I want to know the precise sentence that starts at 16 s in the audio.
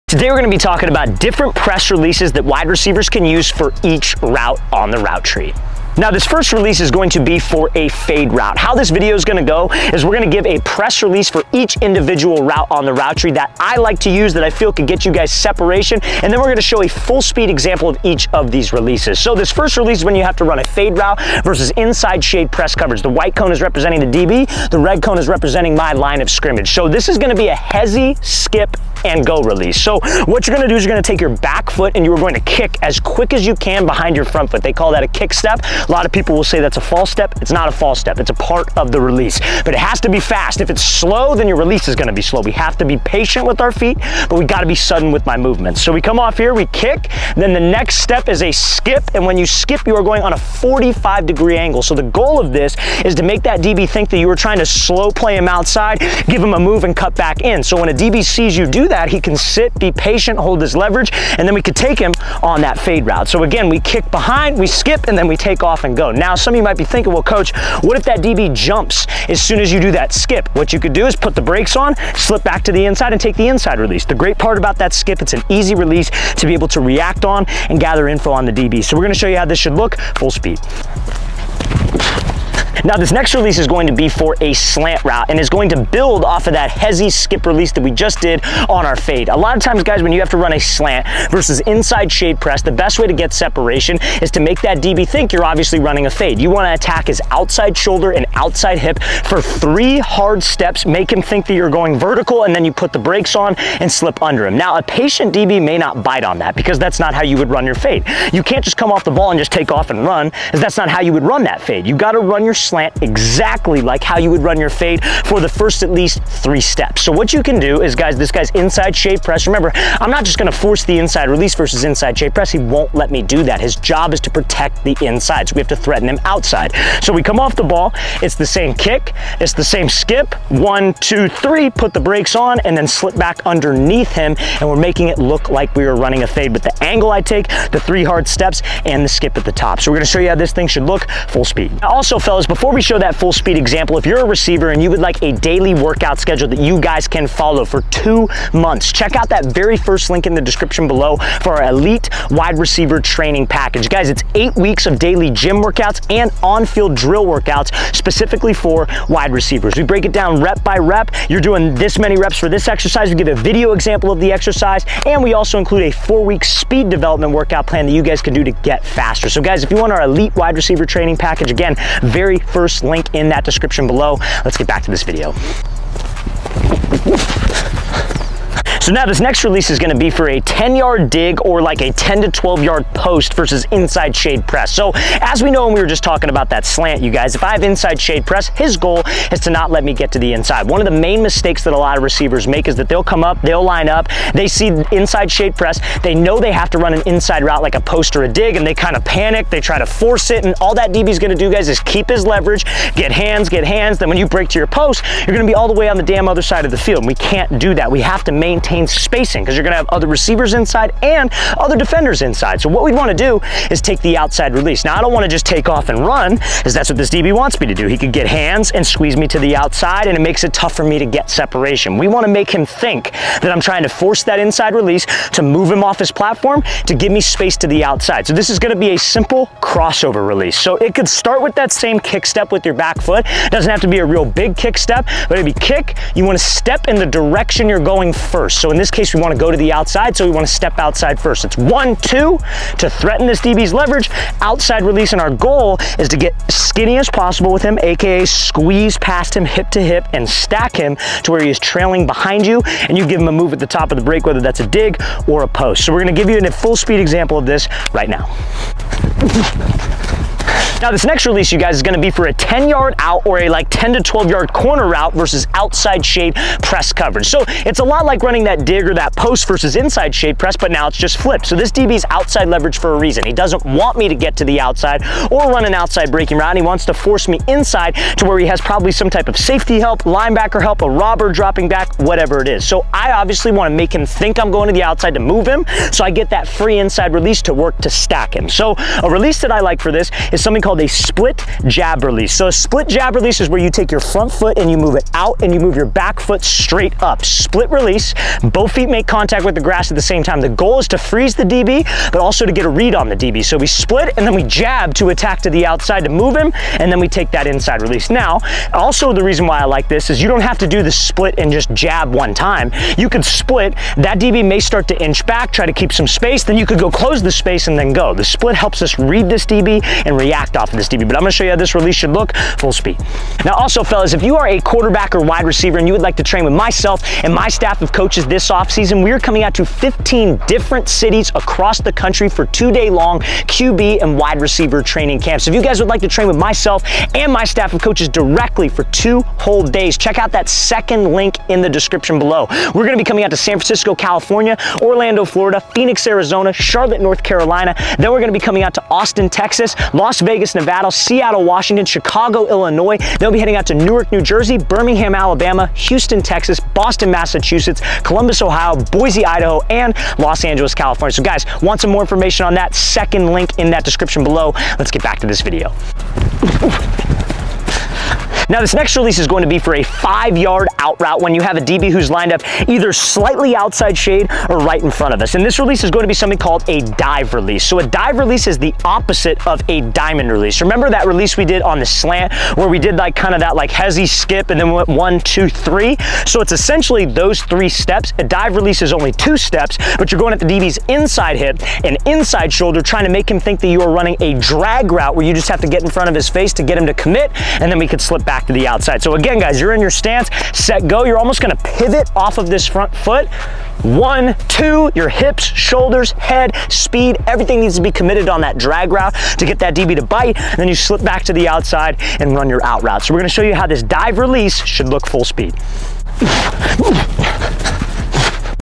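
And then we're gonna show a full speed example of each of these releases.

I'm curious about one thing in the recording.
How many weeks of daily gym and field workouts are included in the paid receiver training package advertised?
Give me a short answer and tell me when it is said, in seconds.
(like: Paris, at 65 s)
8, at 154 s.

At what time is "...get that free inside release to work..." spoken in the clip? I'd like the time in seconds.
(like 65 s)
286 s.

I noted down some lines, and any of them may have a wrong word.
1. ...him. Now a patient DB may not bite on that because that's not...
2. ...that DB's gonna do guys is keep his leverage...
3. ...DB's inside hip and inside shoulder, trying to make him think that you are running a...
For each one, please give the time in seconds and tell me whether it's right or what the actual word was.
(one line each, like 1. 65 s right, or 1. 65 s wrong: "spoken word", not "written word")
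1. 104 s right
2. 200 s right
3. 390 s right.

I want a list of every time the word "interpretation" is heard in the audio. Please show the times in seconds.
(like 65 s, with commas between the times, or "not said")
not said.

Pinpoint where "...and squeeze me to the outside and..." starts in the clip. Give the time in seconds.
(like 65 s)
218 s.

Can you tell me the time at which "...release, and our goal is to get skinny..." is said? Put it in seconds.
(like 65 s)
244 s.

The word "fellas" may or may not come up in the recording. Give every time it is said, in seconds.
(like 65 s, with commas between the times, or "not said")
142 s, 323 s.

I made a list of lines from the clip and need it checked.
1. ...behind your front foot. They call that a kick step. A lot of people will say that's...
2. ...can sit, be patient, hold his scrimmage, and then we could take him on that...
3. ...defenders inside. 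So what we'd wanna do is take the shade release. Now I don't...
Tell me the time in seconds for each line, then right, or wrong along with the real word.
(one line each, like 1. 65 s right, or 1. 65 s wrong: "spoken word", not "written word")
1. 33 s right
2. 59 s wrong: "leverage", not "scrimmage"
3. 211 s wrong: "outside", not "shade".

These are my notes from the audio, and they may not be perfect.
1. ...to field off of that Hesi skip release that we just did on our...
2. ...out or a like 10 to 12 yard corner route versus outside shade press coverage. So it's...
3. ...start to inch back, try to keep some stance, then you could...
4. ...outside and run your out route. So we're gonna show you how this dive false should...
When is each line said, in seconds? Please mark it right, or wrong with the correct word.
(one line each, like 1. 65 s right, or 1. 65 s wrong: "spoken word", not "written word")
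1. 85 s wrong: "build", not "field"
2. 262 s right
3. 314 s wrong: "space", not "stance"
4. 411 s wrong: "release", not "false".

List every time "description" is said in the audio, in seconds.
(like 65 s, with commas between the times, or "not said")
150 s, 173 s, 341 s, 363 s.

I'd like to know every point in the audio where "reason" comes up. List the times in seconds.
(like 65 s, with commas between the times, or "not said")
272 s, 309 s.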